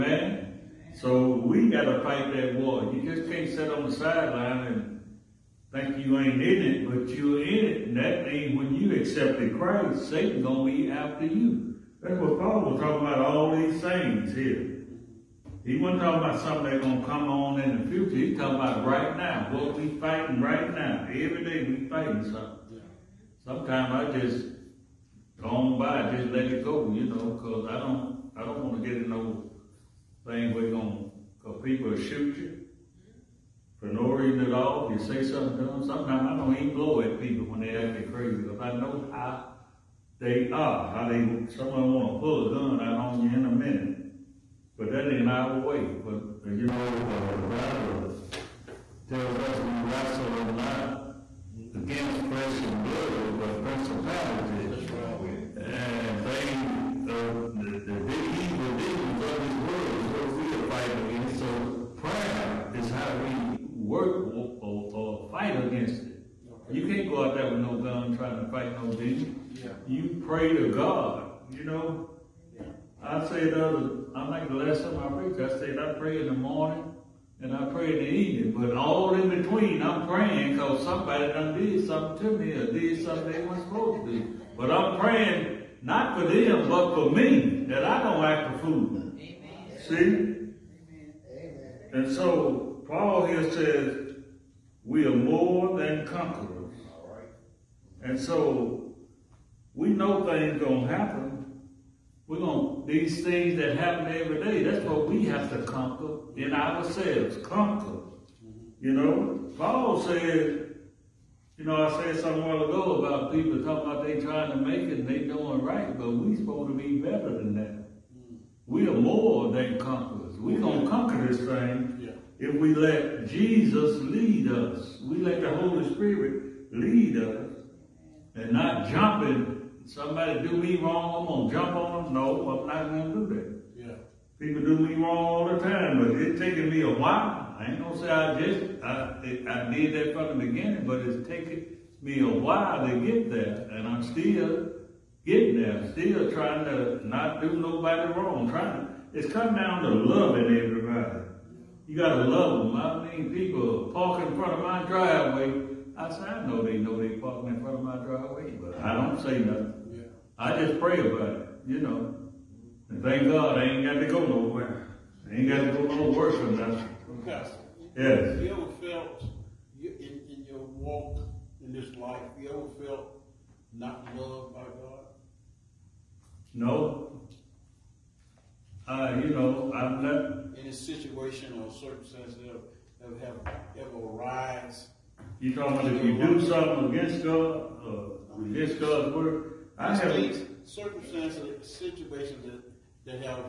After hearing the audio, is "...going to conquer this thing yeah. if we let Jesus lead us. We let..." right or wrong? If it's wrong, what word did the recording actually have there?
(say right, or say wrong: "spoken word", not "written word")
right.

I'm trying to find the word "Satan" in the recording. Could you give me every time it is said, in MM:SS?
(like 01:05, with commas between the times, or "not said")
00:10.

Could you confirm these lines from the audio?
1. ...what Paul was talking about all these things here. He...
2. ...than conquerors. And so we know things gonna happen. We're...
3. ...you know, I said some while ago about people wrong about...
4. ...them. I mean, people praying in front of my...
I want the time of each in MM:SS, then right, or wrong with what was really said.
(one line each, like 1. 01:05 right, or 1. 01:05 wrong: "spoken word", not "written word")
1. 00:12 right
2. 01:35 right
3. 01:51 wrong: "talking", not "wrong"
4. 02:32 wrong: "parking", not "praying".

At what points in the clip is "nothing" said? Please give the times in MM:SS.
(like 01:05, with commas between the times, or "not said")
02:39, 02:46.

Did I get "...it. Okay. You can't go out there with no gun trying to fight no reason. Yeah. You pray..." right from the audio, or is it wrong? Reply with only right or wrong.
wrong.